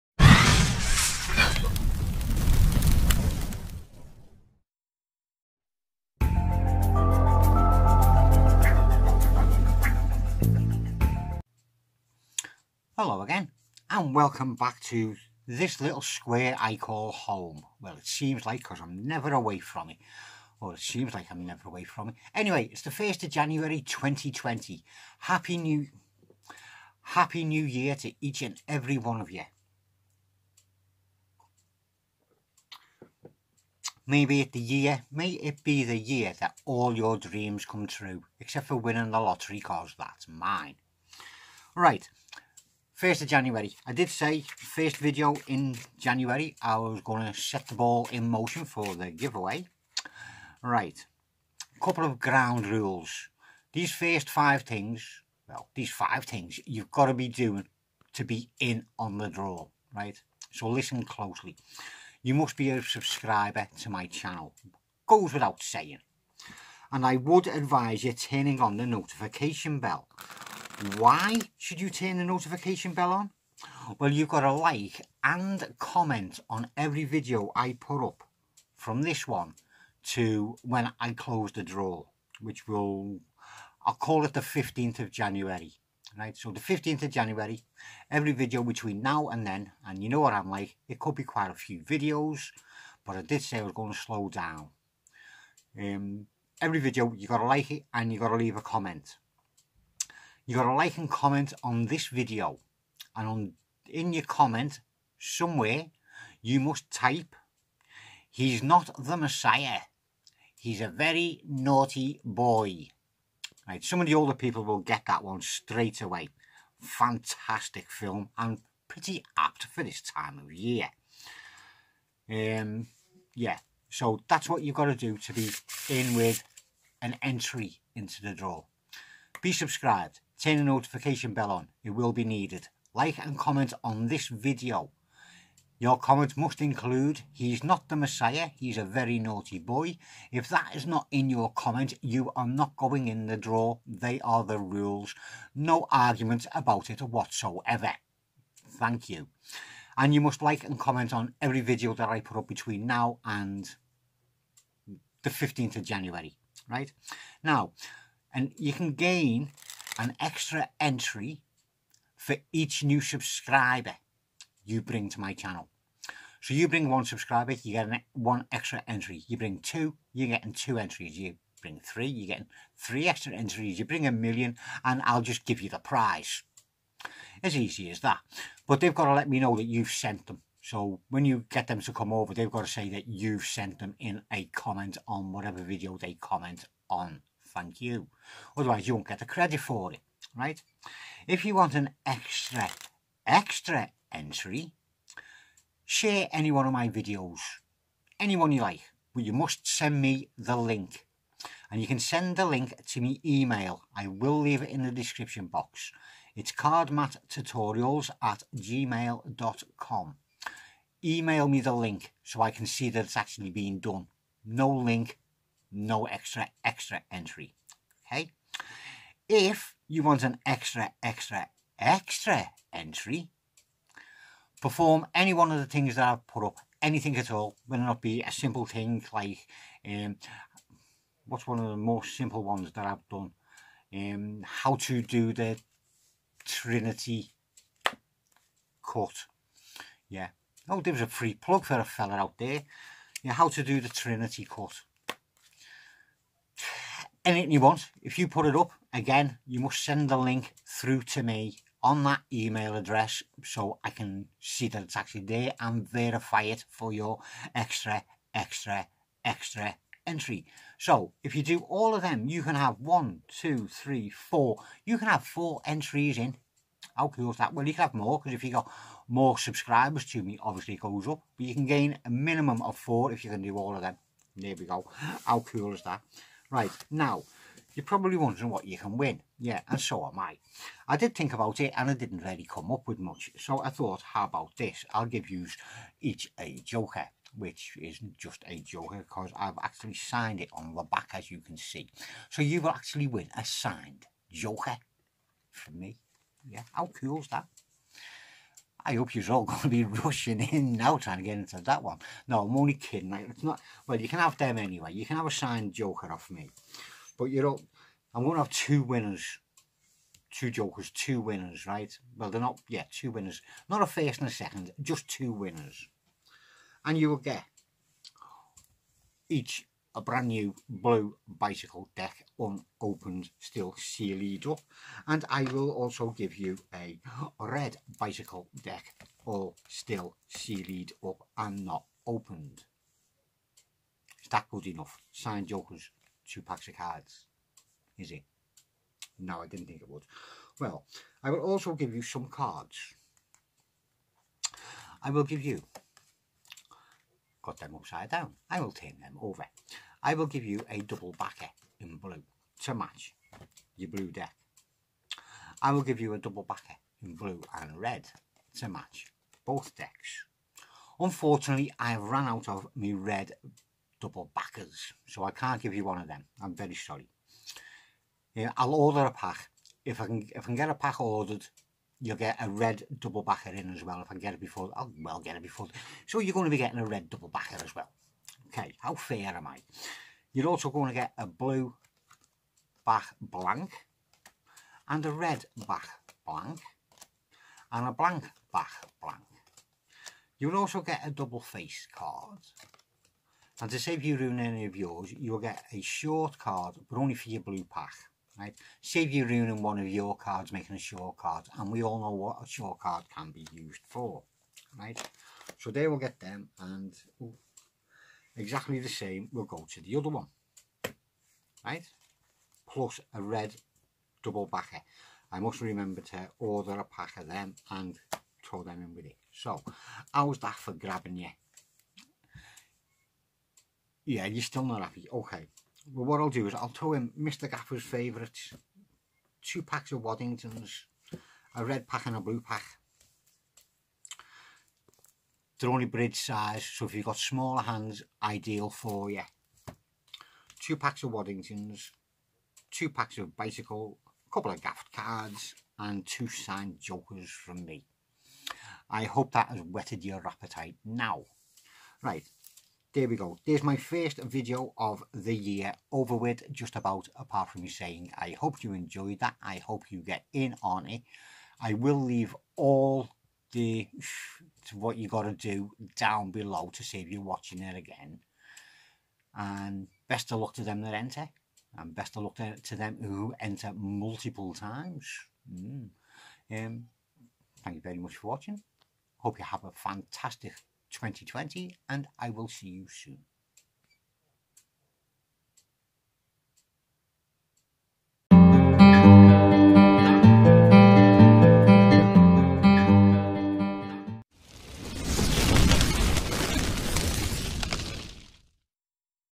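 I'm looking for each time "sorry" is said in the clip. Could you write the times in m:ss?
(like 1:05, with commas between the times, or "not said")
6:06.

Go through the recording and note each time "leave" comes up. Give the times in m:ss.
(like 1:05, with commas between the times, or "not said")
1:38, 3:24, 7:42.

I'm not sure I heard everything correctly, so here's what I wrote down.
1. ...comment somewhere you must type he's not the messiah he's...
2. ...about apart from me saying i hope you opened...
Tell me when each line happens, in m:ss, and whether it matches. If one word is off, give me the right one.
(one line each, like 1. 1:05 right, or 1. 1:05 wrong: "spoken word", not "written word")
1. 1:44 right
2. 7:36 wrong: "enjoyed", not "opened".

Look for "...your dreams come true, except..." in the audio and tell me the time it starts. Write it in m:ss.
0:36.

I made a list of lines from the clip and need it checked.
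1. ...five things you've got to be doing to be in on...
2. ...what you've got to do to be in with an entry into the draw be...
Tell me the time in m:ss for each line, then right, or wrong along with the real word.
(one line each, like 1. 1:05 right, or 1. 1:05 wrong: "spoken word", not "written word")
1. 0:55 right
2. 2:04 right.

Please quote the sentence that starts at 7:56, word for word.
um thank you very much for watching hope you have a fantastic 2020, and I will see you soon.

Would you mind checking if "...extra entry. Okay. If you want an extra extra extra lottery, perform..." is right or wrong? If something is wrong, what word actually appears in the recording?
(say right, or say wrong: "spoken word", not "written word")
wrong: "entry", not "lottery".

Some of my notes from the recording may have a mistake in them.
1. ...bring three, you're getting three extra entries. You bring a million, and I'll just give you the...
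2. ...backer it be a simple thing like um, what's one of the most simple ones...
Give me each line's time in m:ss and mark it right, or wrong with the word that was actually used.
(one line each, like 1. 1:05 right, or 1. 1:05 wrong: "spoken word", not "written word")
1. 2:51 right
2. 3:47 wrong: "whether", not "backer".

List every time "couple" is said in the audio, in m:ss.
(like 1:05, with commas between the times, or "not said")
0:51, 7:24.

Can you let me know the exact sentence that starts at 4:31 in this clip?
But you can gain a minimum of four if you can do all of them.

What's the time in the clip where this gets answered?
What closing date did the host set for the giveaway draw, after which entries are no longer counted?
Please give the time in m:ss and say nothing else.
1:23.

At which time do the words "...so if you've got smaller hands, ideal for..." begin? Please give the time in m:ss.
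7:16.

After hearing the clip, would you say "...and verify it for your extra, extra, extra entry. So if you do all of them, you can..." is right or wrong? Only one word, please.
right.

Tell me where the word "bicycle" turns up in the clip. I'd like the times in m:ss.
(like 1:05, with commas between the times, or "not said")
5:21, 5:27, 7:23.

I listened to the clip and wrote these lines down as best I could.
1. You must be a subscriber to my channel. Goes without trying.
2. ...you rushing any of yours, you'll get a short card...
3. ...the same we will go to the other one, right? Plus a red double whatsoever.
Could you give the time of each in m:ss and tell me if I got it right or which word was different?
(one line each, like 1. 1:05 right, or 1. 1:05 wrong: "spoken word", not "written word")
1. 1:02 wrong: "saying", not "trying"
2. 6:34 wrong: "ruining", not "rushing"
3. 6:48 wrong: "backer", not "whatsoever".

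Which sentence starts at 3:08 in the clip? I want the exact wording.
Otherwise you won't get the credit for it, right?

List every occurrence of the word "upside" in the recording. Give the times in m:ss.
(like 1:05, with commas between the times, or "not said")
5:47.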